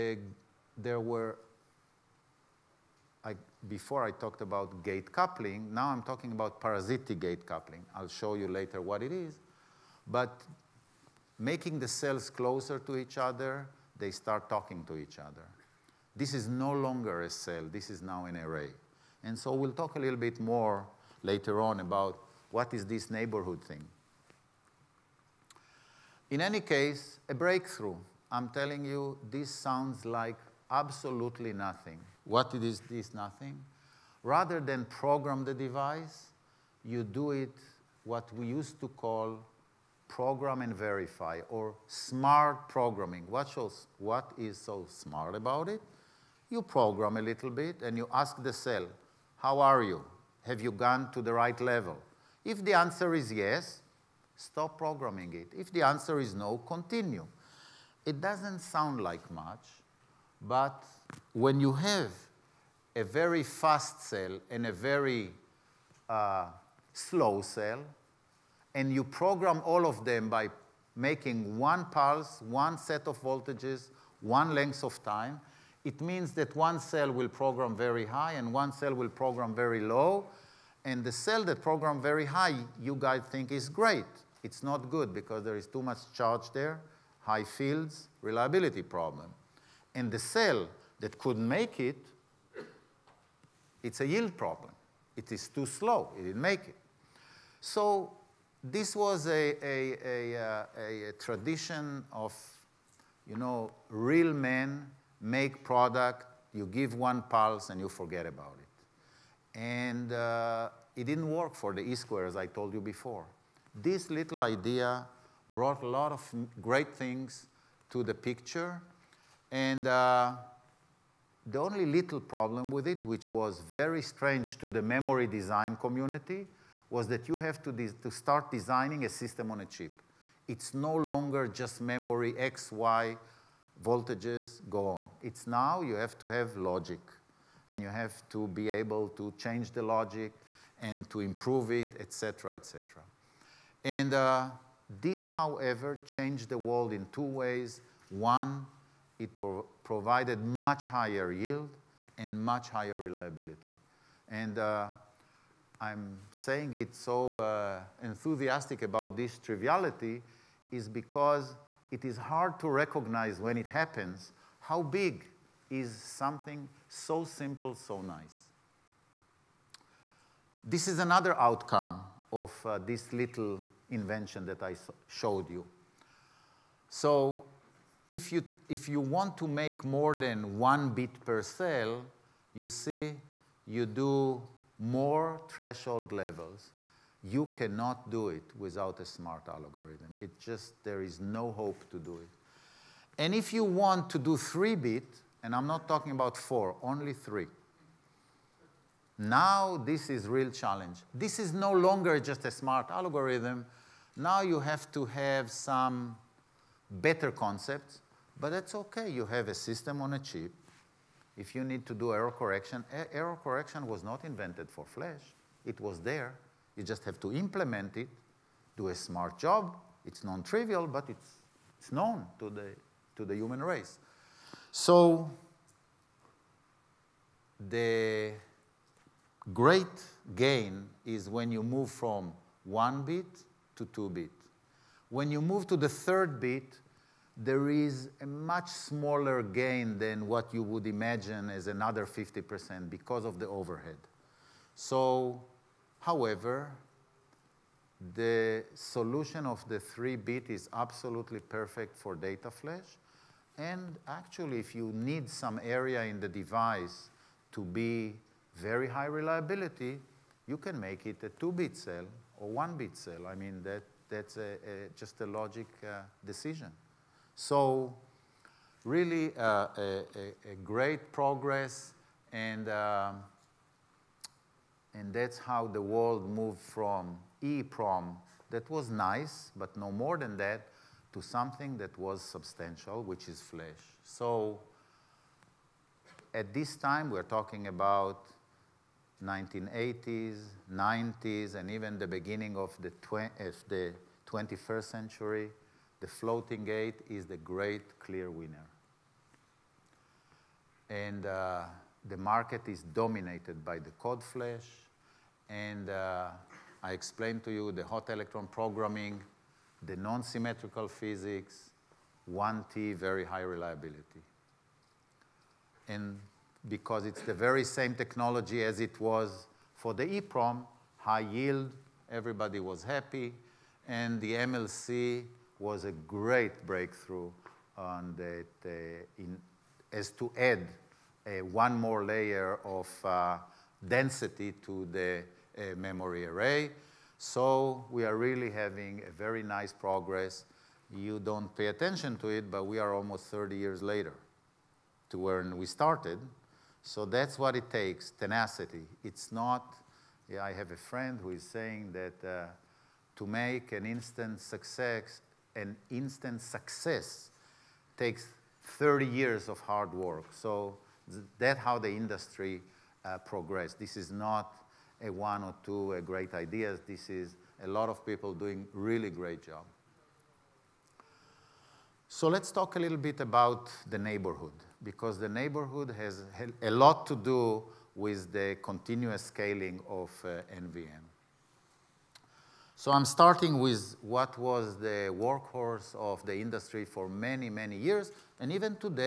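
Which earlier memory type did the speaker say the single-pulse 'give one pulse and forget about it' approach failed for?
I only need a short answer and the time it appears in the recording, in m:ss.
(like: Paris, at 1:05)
E-square, at 1:51.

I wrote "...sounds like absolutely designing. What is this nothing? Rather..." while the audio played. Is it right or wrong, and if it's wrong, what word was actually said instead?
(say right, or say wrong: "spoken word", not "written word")
wrong: "nothing", not "designing".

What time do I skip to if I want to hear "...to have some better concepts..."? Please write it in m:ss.
3:24.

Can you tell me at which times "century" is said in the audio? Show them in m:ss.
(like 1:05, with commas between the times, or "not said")
4:54.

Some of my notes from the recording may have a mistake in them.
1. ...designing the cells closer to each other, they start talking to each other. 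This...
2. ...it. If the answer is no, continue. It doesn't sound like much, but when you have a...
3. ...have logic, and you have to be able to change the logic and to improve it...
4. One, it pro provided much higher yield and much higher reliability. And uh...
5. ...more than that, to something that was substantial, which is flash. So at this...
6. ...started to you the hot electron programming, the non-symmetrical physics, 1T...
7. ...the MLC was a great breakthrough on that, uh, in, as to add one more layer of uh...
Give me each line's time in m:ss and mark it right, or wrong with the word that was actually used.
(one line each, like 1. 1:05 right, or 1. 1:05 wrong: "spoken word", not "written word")
1. 0:11 wrong: "making", not "designing"
2. 0:55 right
3. 2:16 right
4. 2:28 right
5. 4:39 right
6. 5:06 wrong: "explained", not "started"
7. 5:24 right.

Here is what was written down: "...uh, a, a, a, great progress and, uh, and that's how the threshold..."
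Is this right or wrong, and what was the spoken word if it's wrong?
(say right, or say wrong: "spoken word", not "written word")
wrong: "world", not "threshold".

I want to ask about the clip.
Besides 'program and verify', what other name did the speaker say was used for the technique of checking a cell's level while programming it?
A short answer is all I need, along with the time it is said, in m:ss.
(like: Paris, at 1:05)
smart programming, at 0:41.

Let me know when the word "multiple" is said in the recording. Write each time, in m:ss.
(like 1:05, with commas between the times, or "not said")
not said.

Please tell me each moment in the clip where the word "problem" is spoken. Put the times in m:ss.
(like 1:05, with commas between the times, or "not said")
1:28, 1:34, 2:02.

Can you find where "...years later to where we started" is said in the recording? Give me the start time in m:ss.
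5:43.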